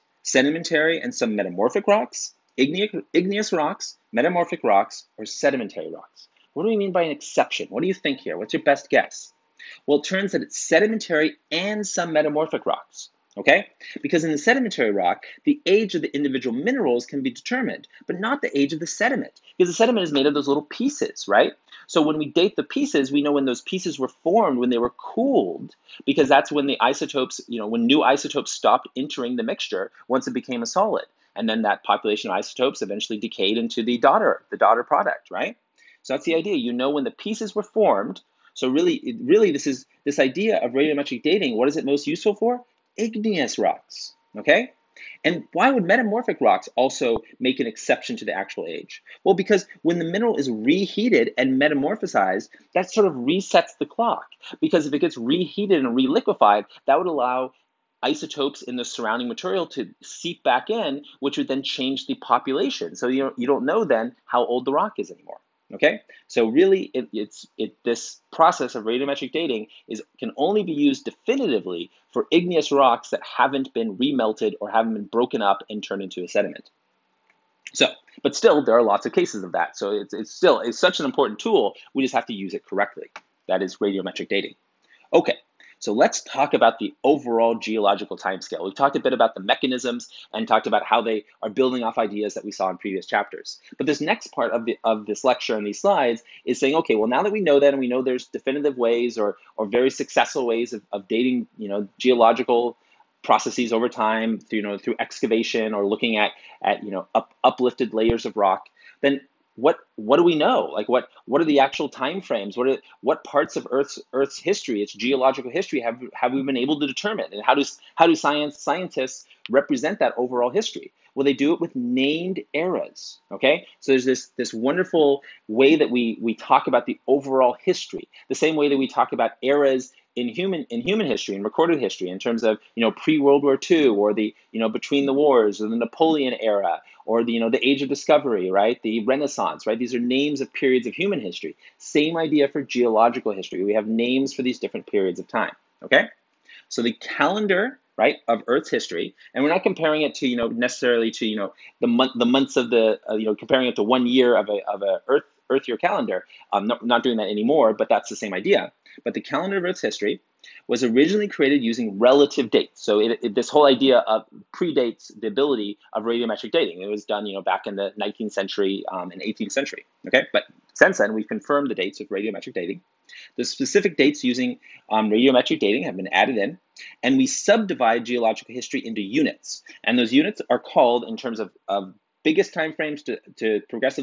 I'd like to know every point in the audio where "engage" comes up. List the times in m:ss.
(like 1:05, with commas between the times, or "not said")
not said.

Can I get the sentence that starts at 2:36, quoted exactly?
I'm not, not doing that anymore, but that's the same idea.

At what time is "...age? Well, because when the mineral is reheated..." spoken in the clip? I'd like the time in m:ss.
0:48.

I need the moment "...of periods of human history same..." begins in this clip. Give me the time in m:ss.
2:20.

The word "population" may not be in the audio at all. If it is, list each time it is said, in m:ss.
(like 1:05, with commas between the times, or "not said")
0:31, 1:02.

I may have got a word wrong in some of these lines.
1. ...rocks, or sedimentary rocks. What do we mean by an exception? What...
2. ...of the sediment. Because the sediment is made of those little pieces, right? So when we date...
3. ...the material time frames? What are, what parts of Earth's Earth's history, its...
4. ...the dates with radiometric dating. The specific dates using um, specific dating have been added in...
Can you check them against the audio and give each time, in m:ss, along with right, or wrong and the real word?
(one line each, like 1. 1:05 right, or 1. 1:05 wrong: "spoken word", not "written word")
1. 0:04 right
2. 0:18 right
3. 1:51 wrong: "actual", not "material"
4. 2:51 wrong: "radiometric", not "specific".